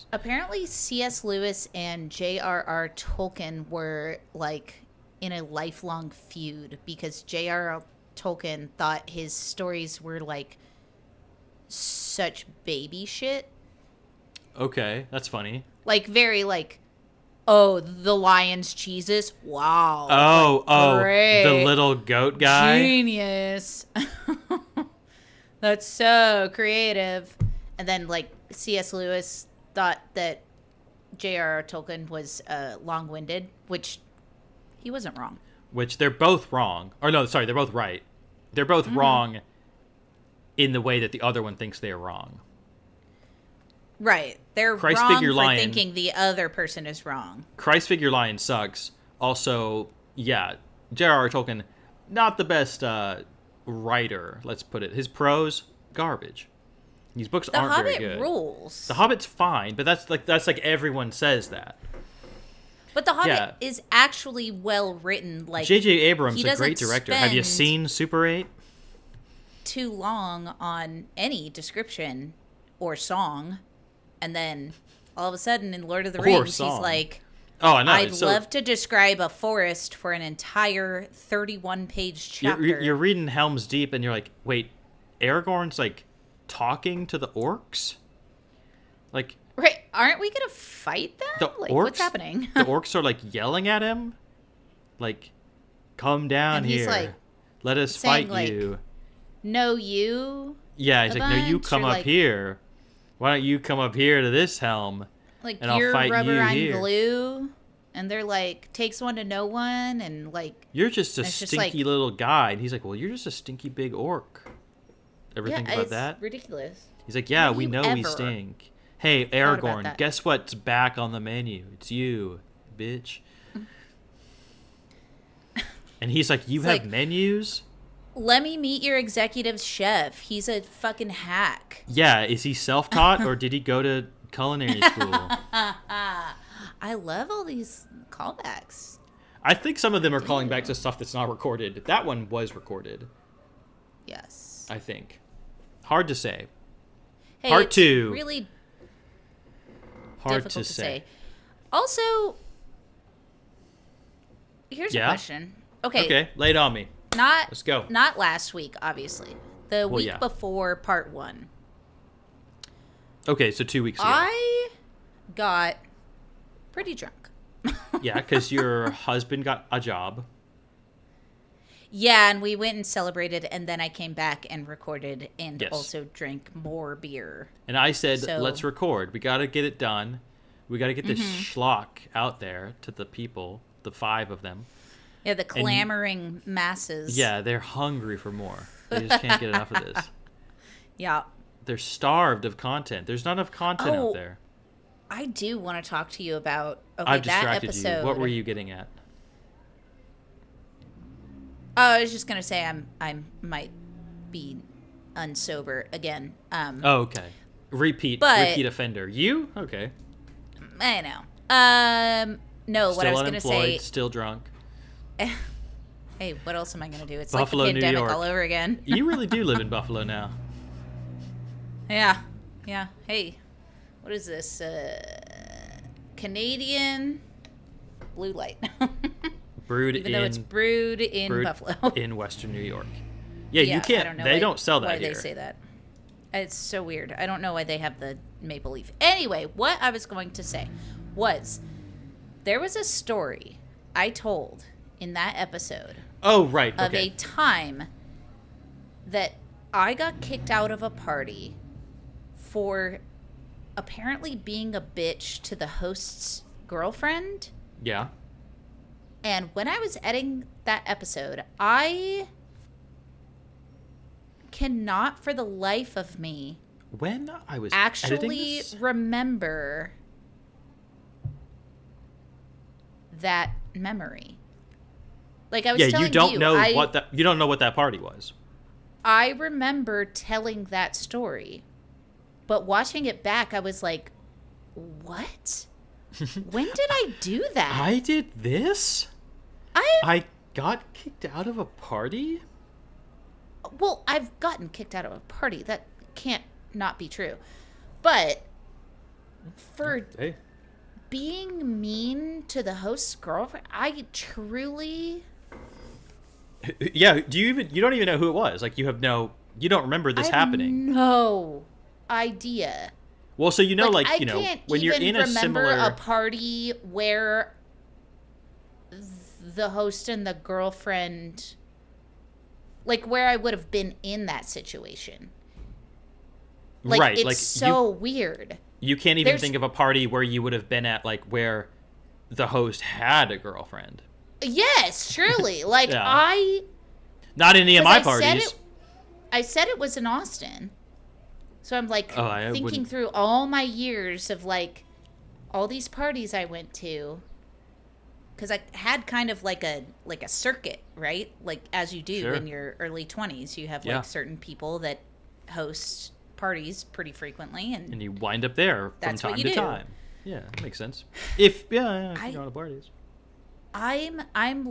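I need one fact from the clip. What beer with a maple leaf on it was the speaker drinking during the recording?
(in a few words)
Canadian blue light.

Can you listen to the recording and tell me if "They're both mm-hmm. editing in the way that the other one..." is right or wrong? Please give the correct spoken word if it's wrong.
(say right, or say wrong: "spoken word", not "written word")
wrong: "wrong", not "editing".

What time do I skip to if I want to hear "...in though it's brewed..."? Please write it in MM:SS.
03:50.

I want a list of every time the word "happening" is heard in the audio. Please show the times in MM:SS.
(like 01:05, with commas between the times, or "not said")
01:31, 05:10.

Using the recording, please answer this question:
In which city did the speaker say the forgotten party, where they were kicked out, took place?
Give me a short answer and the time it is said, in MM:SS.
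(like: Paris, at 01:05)
Austin, at 05:40.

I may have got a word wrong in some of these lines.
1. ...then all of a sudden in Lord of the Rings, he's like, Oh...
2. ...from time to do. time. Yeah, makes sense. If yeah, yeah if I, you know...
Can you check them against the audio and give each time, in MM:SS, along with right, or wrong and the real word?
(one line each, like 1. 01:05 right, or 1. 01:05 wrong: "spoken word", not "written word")
1. 01:14 right
2. 05:59 right.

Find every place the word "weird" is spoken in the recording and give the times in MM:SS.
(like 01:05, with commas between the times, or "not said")
03:56, 05:27.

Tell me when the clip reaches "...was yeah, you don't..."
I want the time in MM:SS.
04:35.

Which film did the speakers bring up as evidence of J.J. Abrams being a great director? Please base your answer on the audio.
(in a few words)
Super Eight.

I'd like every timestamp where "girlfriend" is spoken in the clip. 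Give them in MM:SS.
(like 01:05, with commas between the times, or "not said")
04:16, 05:03, 05:20, 05:33.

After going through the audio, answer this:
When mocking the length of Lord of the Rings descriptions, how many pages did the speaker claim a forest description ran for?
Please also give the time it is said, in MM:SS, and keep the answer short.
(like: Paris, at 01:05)
31, at 01:21.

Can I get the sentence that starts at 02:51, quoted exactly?
Yeah, and we went and celebrated, and then I came back and recorded and yes.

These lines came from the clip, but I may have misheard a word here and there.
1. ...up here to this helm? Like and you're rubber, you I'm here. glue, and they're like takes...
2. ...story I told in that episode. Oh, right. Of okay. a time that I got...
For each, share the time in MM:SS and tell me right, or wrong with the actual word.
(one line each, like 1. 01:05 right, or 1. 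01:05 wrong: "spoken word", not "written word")
1. 01:43 right
2. 04:02 right.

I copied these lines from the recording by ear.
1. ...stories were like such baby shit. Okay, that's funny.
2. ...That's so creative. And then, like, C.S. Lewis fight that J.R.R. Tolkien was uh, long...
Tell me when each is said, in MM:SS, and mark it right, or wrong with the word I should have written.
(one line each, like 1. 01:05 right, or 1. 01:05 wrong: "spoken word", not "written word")
1. 00:09 right
2. 00:25 wrong: "thought", not "fight".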